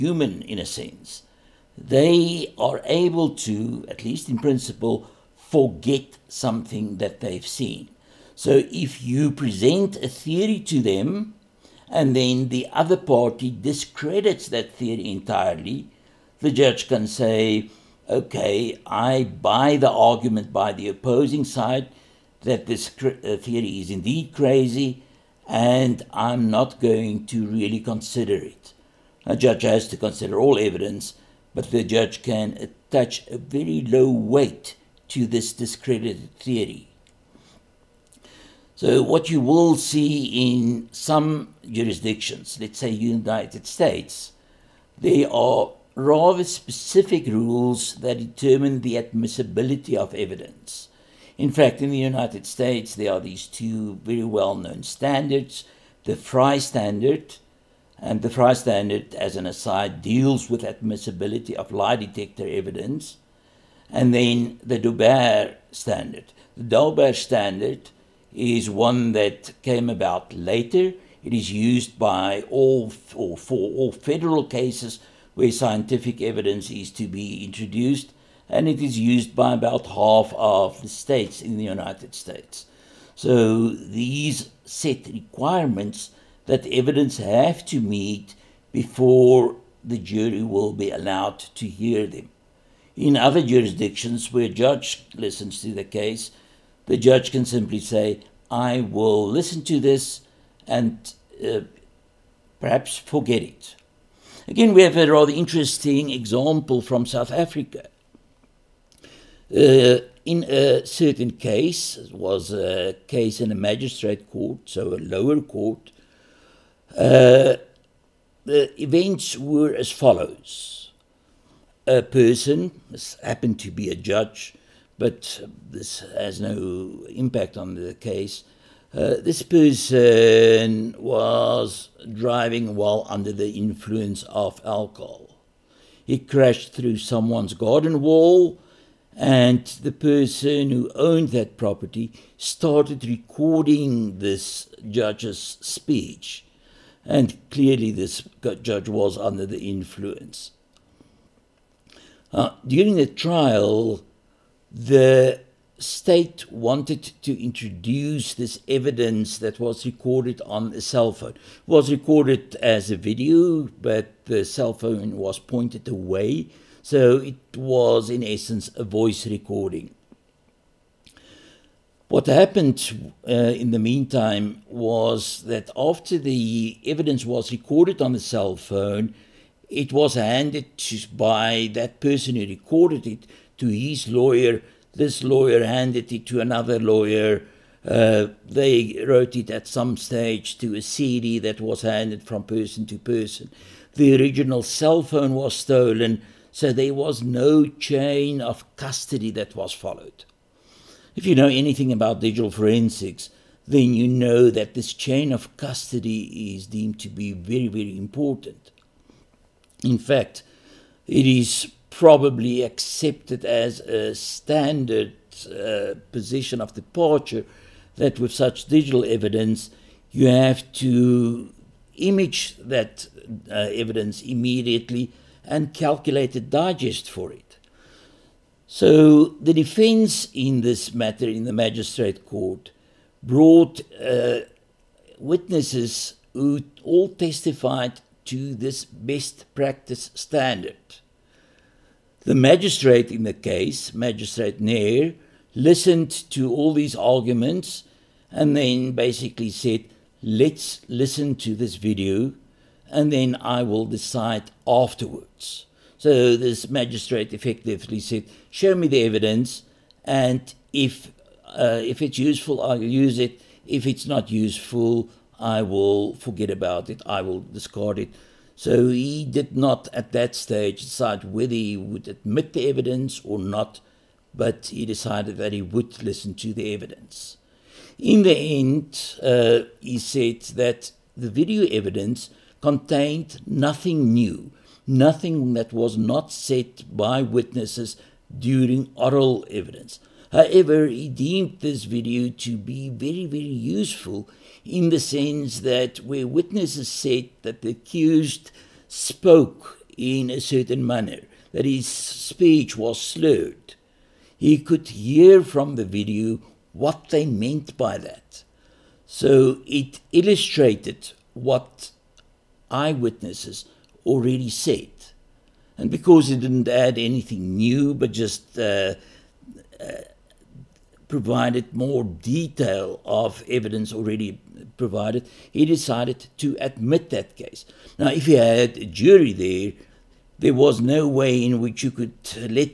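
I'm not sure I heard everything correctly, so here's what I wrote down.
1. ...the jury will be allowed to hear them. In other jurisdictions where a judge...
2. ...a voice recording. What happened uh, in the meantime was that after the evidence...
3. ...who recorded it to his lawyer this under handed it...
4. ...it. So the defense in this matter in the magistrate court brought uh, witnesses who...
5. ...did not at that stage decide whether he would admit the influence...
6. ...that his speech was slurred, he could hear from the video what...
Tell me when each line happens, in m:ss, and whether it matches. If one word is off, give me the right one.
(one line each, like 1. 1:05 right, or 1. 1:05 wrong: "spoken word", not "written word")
1. 1:29 right
2. 2:48 right
3. 3:02 wrong: "lawyer", not "under"
4. 3:47 right
5. 4:29 wrong: "evidence", not "influence"
6. 5:01 right.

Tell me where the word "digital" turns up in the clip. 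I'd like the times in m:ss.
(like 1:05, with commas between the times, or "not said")
3:22, 3:38.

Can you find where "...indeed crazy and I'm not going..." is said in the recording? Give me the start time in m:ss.
0:23.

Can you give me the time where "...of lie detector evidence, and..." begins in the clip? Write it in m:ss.
1:01.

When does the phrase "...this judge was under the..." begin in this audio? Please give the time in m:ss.
2:27.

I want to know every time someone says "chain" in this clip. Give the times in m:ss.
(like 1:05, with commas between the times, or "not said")
3:17, 3:24.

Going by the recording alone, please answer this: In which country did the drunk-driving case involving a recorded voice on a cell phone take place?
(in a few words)
South Africa.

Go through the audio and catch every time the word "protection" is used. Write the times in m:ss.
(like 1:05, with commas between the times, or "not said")
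not said.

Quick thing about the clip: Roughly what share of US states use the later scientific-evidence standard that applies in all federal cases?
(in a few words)
about half.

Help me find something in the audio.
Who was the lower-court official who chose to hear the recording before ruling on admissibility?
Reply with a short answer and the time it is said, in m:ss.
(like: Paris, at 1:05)
Magistrate Nair, at 4:03.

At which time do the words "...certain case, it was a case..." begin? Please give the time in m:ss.
1:50.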